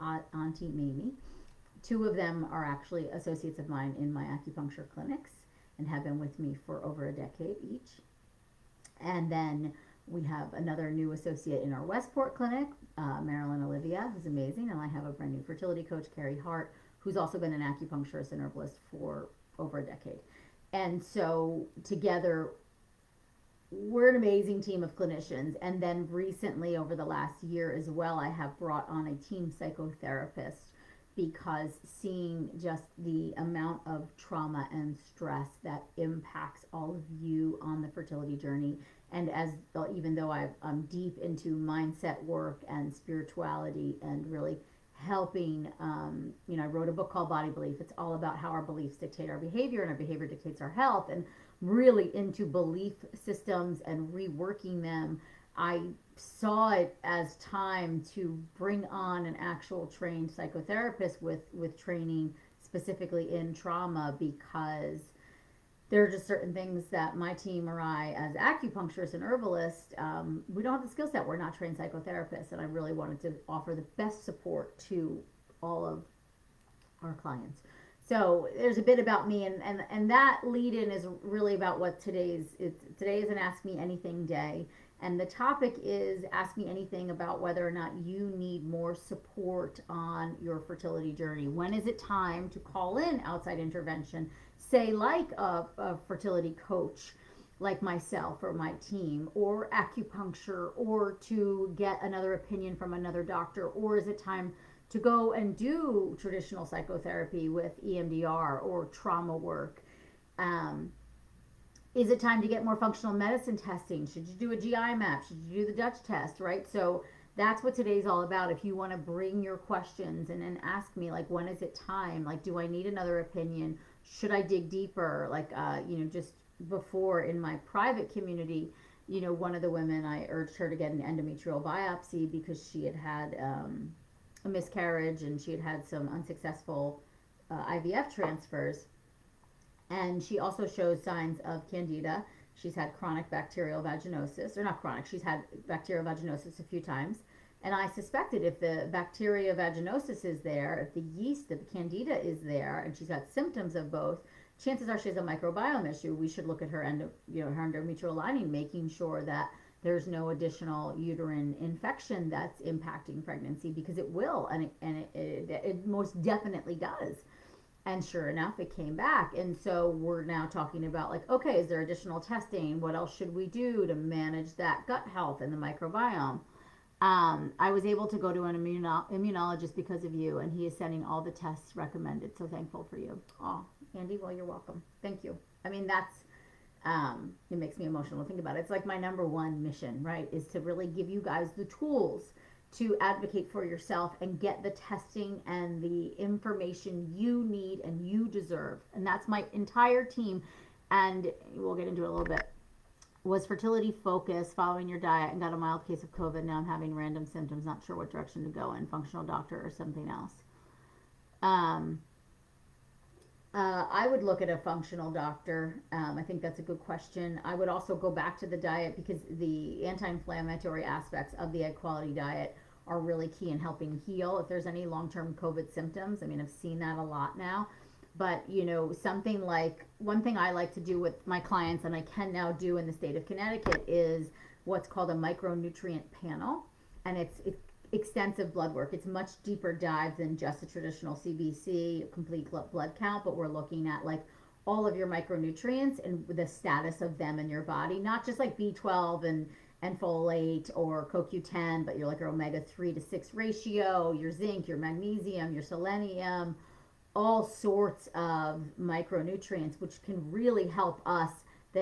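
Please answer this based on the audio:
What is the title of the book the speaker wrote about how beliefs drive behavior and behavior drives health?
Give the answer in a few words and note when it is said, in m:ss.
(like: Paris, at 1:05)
Body Belief, at 0:47.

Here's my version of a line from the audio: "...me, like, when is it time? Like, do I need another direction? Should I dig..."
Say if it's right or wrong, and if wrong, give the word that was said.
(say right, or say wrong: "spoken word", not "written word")
wrong: "opinion", not "direction".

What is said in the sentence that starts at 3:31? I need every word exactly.
Um, uh, I would look at a functional doctor.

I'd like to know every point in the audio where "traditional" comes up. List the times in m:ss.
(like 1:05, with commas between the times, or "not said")
1:46, 4:00.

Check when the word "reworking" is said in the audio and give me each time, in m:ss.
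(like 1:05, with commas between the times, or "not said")
0:54.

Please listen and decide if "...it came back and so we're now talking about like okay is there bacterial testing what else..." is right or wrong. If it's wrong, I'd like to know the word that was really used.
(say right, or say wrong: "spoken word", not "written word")
wrong: "additional", not "bacterial".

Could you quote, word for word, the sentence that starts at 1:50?
Um, is it time to get more functional medicine testing?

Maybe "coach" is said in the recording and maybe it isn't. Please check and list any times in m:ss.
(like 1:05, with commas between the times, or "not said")
0:15, 1:36.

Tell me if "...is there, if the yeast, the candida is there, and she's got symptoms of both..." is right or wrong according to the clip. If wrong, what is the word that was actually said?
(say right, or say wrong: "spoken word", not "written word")
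right.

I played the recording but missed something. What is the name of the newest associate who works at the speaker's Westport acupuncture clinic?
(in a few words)
Marilyn Olivia.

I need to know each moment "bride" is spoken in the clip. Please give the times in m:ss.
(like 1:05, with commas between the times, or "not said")
not said.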